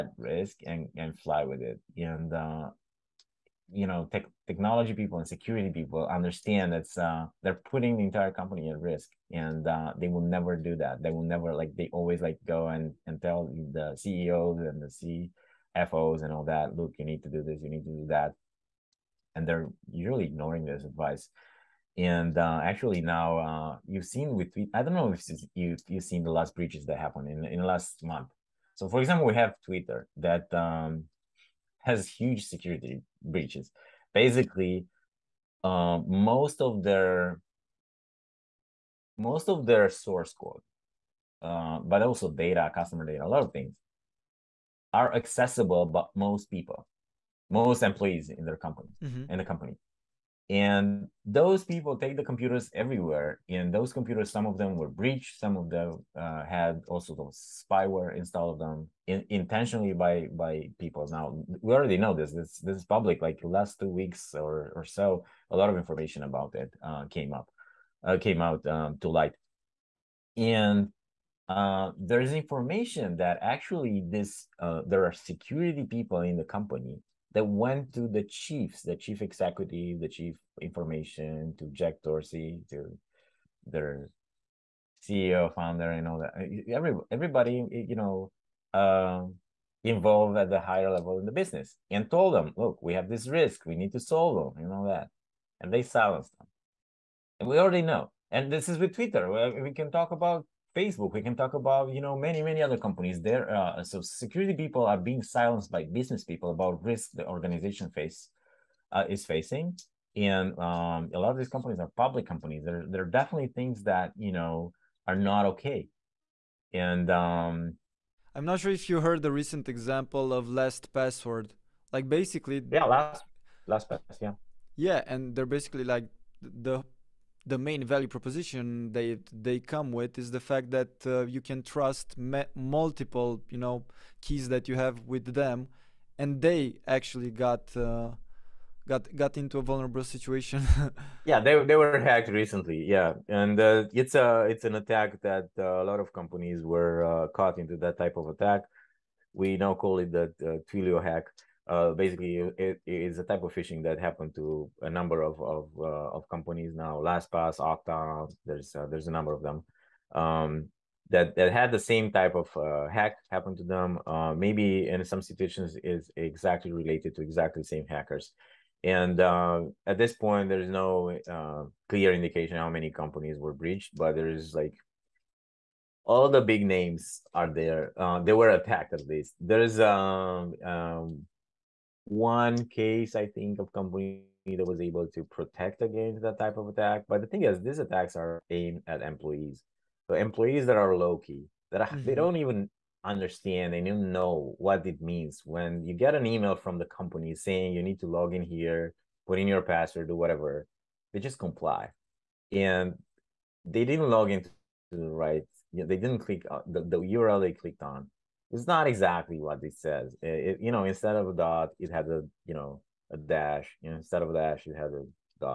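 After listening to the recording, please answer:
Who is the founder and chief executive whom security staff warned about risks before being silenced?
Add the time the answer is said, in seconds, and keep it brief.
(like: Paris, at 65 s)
Jack Dorsey, at 81 s.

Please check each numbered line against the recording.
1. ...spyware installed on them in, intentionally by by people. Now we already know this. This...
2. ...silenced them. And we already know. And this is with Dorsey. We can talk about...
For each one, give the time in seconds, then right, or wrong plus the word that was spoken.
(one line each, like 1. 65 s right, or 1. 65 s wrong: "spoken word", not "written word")
1. 57 s right
2. 95 s wrong: "Twitter", not "Dorsey".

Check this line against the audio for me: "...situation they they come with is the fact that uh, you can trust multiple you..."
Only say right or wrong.
wrong.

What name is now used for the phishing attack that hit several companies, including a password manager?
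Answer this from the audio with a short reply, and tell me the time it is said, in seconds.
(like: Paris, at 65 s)
Twilio hack, at 150 s.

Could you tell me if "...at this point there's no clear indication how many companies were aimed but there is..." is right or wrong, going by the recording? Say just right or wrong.
wrong.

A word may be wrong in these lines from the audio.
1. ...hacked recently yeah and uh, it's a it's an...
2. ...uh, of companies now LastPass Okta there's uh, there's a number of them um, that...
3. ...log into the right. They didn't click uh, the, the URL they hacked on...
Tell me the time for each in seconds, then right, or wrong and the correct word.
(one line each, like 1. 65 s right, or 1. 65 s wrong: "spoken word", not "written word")
1. 142 s right
2. 155 s right
3. 204 s wrong: "clicked", not "hacked".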